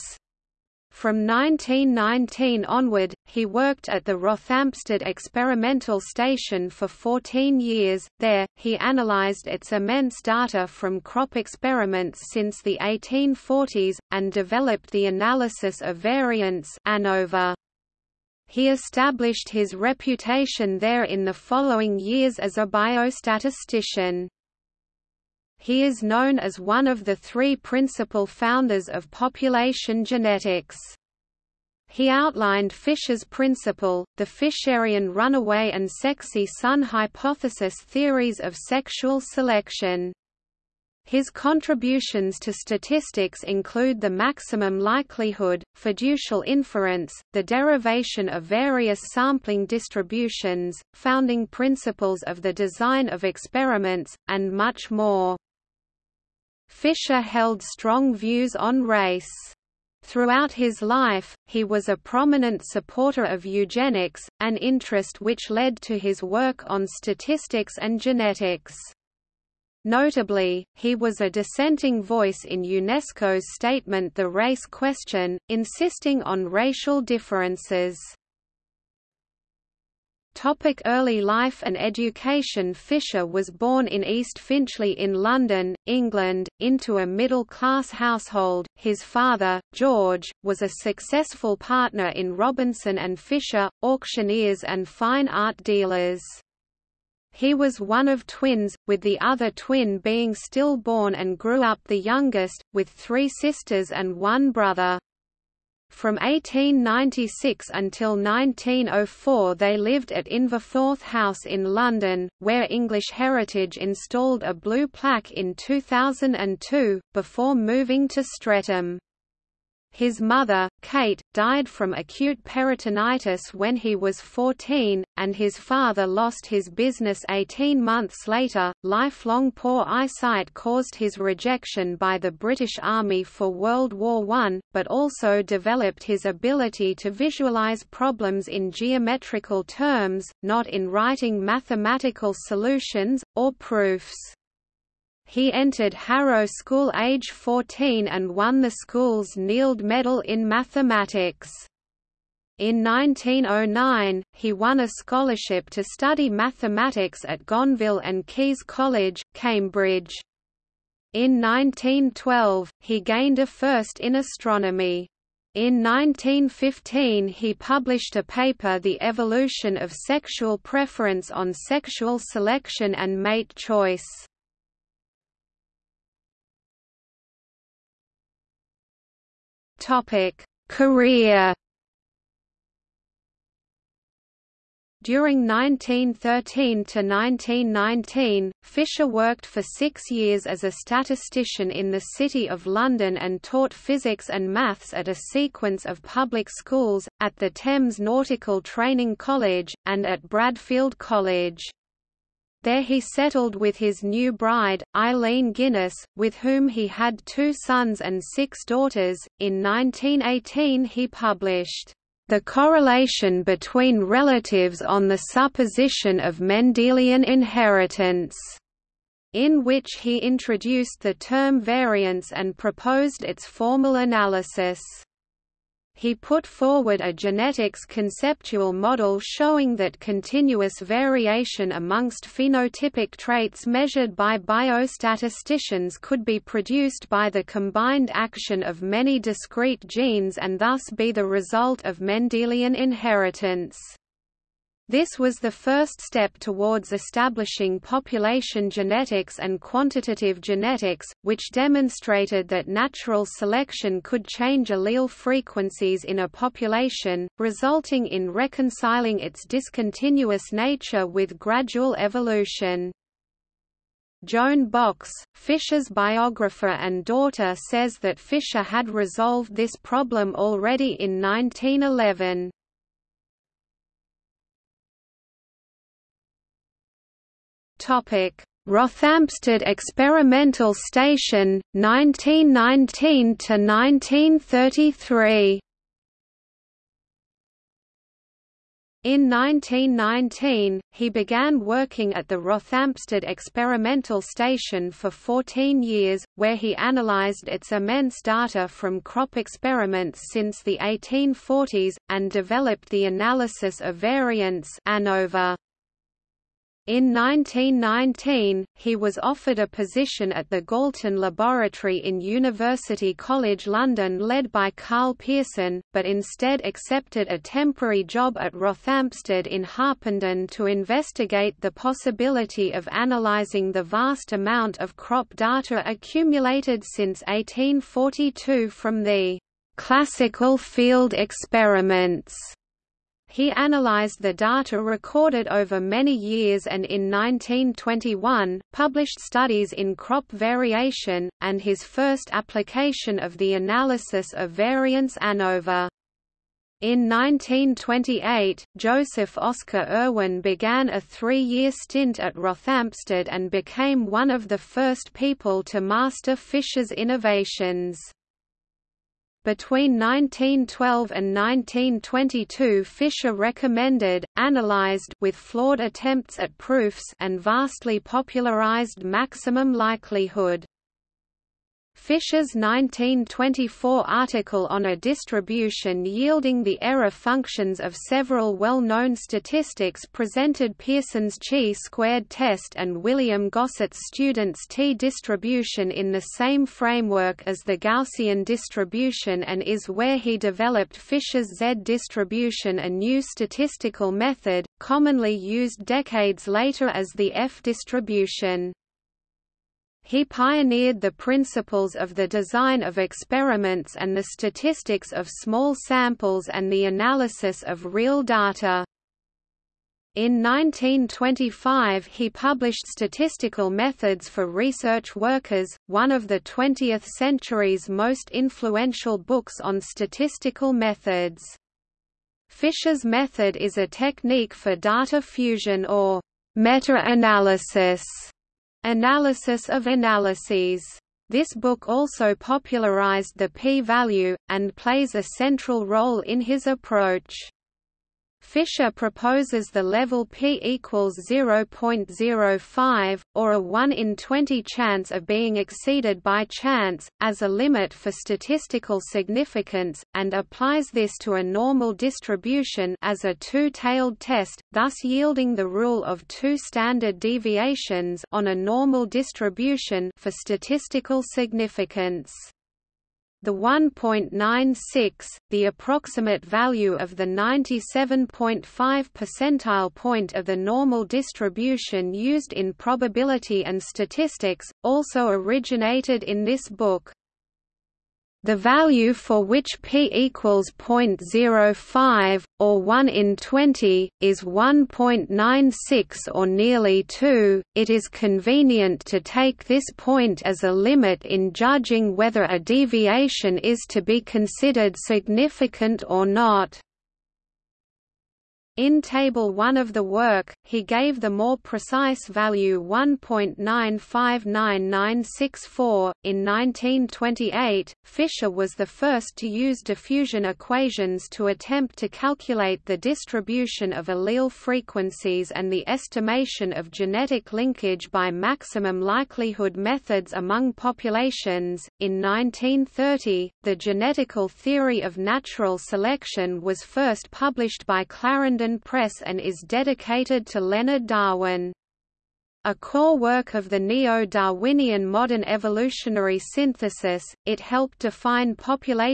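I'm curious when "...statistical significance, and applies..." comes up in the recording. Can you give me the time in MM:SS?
07:28.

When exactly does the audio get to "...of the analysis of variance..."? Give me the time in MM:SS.
05:43.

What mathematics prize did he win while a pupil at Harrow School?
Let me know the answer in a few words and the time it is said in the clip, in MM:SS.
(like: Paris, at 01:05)
Neild Medal, at 02:29.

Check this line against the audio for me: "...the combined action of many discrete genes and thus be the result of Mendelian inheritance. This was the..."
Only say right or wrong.
right.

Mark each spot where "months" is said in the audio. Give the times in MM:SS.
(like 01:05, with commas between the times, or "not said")
02:07.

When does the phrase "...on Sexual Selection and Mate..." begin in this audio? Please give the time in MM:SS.
02:51.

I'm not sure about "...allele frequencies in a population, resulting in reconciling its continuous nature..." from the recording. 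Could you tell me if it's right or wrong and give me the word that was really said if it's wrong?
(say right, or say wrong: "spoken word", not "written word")
wrong: "discontinuous", not "continuous".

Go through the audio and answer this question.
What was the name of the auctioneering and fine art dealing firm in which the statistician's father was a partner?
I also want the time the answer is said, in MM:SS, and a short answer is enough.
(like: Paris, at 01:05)
Robinson and Fisher, at 01:32.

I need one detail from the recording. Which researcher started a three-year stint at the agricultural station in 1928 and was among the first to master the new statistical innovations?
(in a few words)
Joseph Oscar Irwin.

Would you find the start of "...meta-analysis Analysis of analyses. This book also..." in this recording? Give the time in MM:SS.
07:06.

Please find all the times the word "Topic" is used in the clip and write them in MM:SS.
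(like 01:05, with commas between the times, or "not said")
01:20, 02:59.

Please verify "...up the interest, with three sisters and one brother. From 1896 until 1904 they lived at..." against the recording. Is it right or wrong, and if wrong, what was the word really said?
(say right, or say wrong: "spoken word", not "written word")
wrong: "youngest", not "interest".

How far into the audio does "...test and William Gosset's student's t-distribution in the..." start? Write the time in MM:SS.
06:22.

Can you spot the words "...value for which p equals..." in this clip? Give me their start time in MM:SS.
07:58.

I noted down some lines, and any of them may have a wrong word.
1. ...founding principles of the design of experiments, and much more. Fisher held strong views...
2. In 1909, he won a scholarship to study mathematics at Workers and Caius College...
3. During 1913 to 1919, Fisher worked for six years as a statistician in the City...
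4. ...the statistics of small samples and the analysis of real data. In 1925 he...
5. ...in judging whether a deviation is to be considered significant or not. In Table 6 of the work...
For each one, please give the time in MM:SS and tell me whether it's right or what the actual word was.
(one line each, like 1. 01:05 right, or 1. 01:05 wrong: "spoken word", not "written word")
1. 00:50 right
2. 02:32 wrong: "Gonville", not "Workers"
3. 03:05 right
4. 06:44 right
5. 08:11 wrong: "1", not "6".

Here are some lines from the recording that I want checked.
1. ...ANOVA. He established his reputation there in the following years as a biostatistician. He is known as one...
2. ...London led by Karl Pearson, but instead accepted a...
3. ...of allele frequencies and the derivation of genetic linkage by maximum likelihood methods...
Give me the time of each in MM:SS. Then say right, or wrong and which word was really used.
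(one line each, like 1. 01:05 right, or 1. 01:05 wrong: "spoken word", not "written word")
1. 00:16 right
2. 05:13 right
3. 08:33 wrong: "estimation", not "derivation".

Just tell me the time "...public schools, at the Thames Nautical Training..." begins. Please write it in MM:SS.
03:16.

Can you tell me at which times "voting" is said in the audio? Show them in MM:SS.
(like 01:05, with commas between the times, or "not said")
not said.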